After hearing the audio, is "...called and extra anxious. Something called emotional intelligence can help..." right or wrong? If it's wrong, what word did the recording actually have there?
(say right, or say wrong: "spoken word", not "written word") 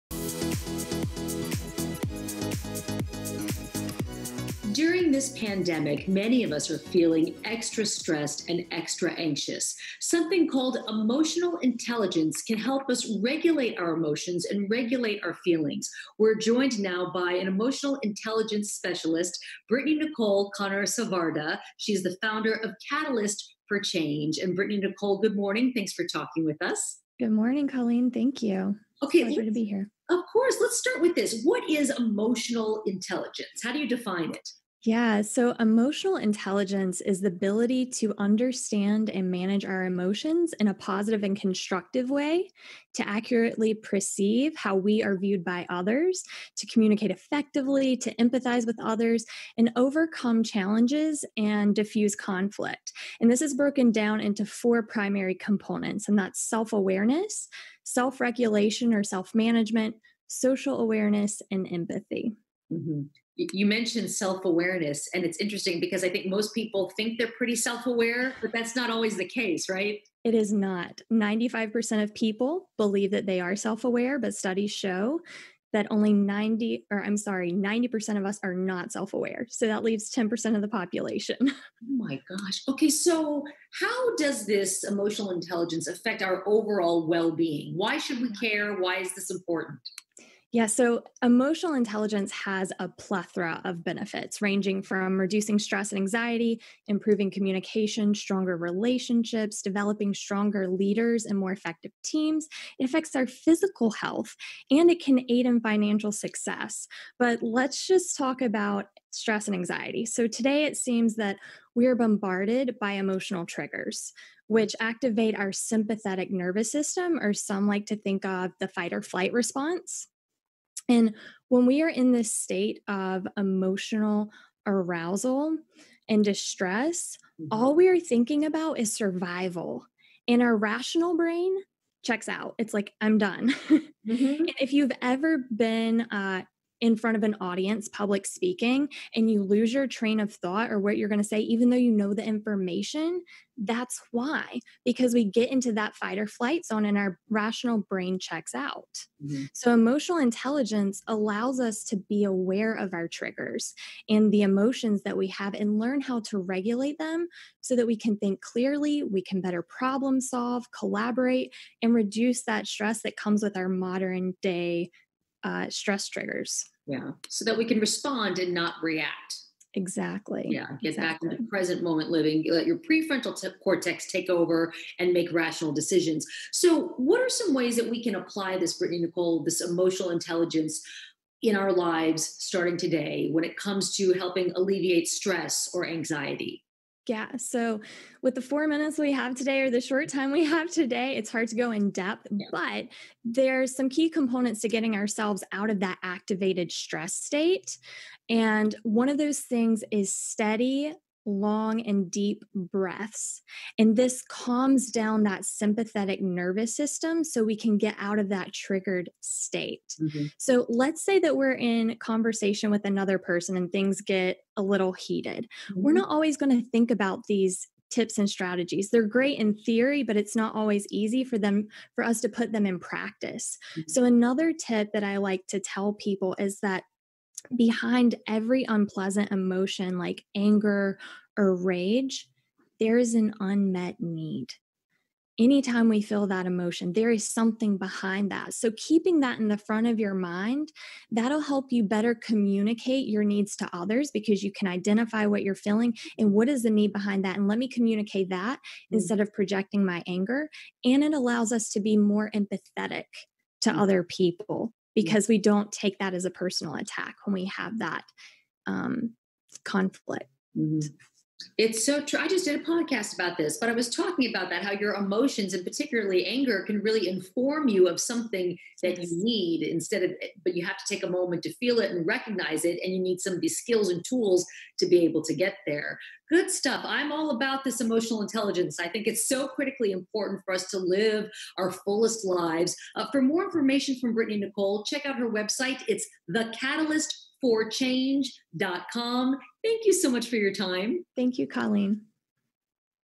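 wrong: "stressed", not "called".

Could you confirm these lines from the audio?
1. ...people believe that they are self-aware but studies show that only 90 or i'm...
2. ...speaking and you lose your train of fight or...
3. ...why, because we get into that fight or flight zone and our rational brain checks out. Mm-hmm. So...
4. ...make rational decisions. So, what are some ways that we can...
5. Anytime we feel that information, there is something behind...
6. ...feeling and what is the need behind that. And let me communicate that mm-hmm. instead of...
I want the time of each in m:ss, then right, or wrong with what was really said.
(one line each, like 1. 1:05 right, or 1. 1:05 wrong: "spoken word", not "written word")
1. 1:12 right
2. 2:18 wrong: "thought", not "fight"
3. 2:24 right
4. 2:55 right
5. 3:55 wrong: "emotion", not "information"
6. 4:05 right.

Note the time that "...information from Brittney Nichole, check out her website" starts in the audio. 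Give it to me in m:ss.
4:43.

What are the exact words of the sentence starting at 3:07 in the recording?
So, with the four minutes we have today or the short time we have today, it's hard to go in depth, yeah.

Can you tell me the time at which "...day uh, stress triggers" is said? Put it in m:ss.
2:44.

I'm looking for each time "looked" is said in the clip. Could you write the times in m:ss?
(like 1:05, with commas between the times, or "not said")
not said.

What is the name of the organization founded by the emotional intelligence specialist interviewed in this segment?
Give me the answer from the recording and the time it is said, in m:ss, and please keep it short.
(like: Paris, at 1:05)
Catalyst for Change, at 0:22.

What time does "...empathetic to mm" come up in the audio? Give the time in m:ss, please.
4:12.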